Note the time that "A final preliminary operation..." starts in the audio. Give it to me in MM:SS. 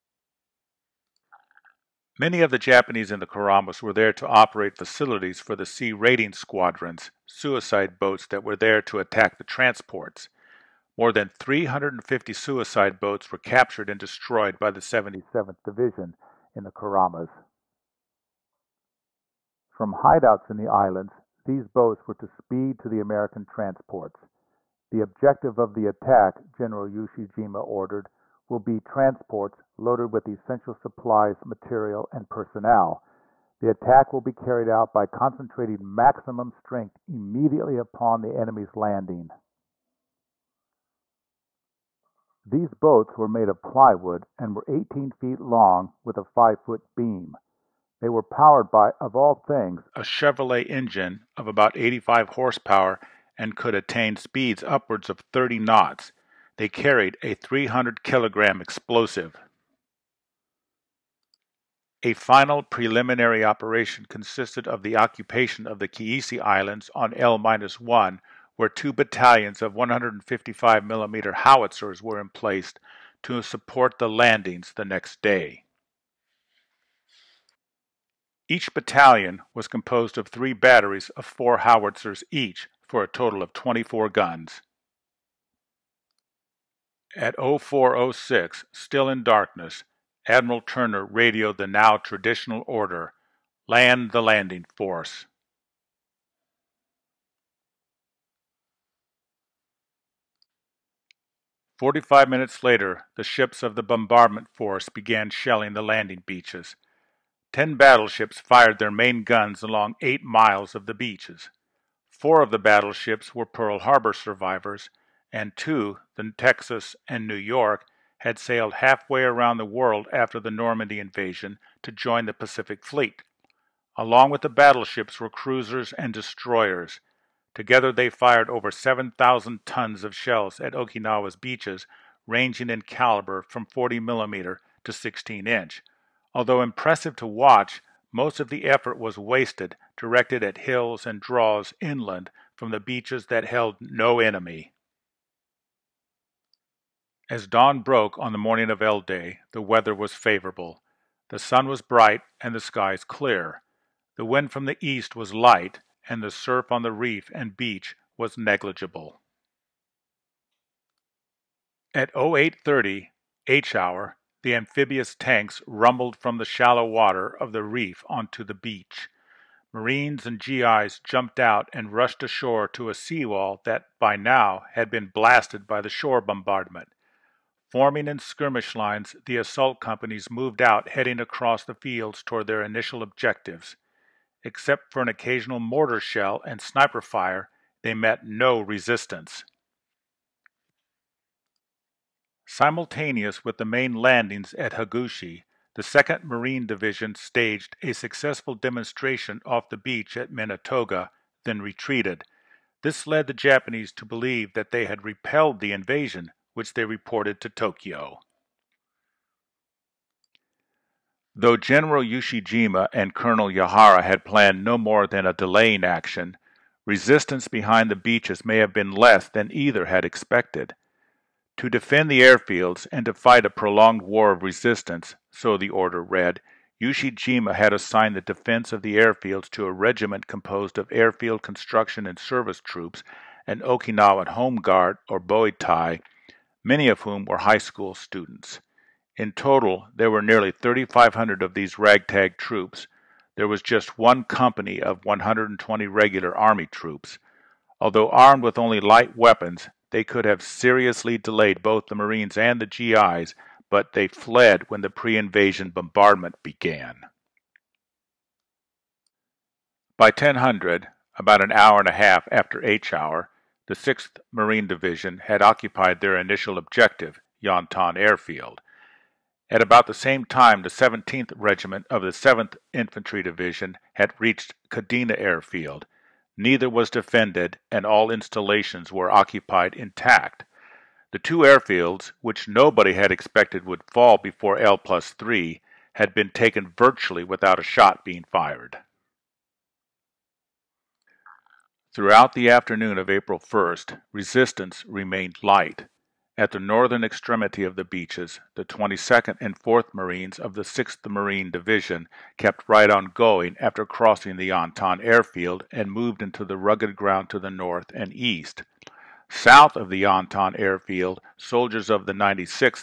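01:02.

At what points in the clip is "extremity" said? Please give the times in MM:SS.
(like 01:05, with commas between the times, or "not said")
04:57.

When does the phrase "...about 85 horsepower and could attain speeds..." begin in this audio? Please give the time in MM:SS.
00:51.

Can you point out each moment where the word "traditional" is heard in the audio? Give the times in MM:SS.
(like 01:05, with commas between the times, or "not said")
01:31.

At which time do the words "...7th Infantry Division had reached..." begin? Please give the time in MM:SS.
04:32.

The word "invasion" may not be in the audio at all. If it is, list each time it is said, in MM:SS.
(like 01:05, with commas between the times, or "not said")
02:00, 03:25, 04:15.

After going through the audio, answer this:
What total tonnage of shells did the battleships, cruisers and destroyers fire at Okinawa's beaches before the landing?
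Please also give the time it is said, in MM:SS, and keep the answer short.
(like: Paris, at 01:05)
over 7,000 tons, at 02:08.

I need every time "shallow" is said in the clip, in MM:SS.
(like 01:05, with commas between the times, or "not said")
02:46.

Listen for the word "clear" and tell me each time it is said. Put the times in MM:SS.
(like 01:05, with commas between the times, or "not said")
02:33.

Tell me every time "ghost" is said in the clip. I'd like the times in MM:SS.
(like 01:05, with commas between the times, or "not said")
not said.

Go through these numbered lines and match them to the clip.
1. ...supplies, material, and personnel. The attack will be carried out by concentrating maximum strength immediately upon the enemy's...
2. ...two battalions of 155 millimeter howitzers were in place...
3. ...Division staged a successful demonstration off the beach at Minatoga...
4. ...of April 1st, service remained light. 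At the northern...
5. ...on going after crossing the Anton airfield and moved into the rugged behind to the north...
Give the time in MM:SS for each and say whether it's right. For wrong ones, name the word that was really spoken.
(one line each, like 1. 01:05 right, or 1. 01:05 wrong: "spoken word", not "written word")
1. 00:30 right
2. 01:08 right
3. 03:16 right
4. 04:52 wrong: "resistance", not "service"
5. 05:02 wrong: "ground", not "behind".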